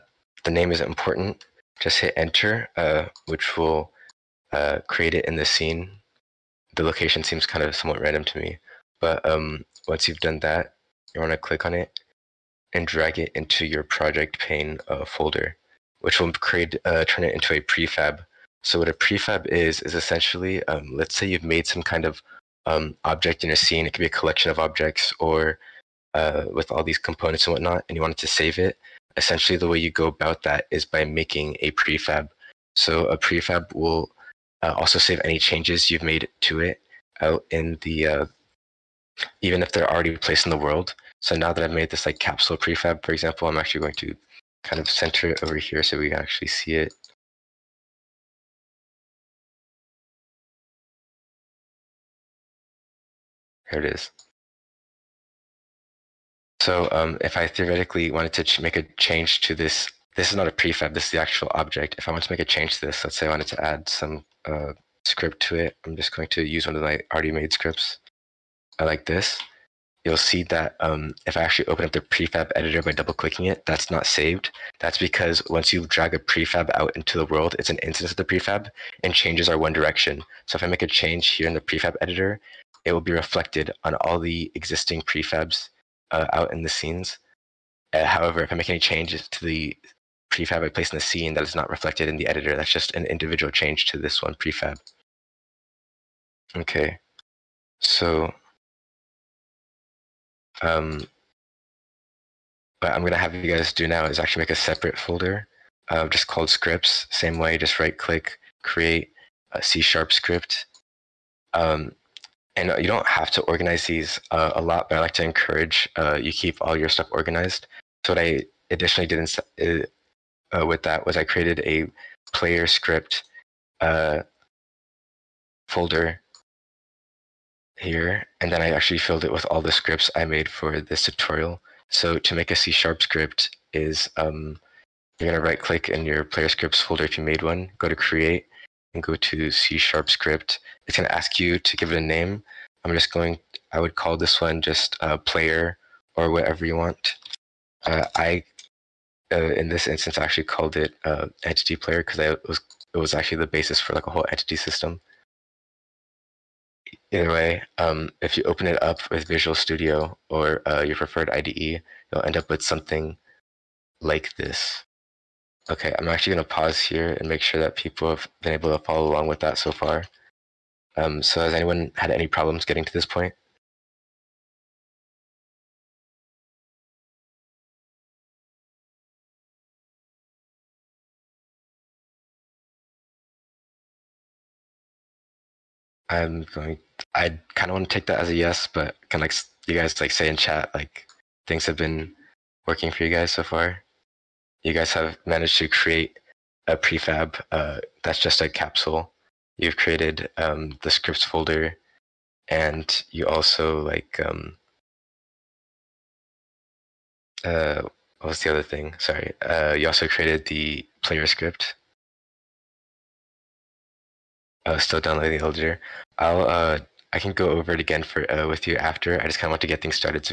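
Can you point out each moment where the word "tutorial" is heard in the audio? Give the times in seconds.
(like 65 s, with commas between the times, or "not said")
131 s.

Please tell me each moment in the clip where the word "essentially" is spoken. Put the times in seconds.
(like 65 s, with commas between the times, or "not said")
19 s, 29 s.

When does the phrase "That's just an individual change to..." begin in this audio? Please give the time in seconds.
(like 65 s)
92 s.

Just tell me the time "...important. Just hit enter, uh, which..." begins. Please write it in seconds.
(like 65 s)
0 s.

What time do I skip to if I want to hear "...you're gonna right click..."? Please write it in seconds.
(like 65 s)
135 s.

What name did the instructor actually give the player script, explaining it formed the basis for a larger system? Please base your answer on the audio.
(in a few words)
entity player.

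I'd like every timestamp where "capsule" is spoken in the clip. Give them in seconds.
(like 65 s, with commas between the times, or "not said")
42 s, 198 s.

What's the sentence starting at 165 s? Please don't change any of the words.
Okay, I'm actually going to pause here and make sure that people have been able to follow along with that so far.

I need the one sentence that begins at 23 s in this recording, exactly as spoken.
It could be a collection of objects or uh, with all these components and whatnot, and you wanted to save it.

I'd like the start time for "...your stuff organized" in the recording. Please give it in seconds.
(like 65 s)
116 s.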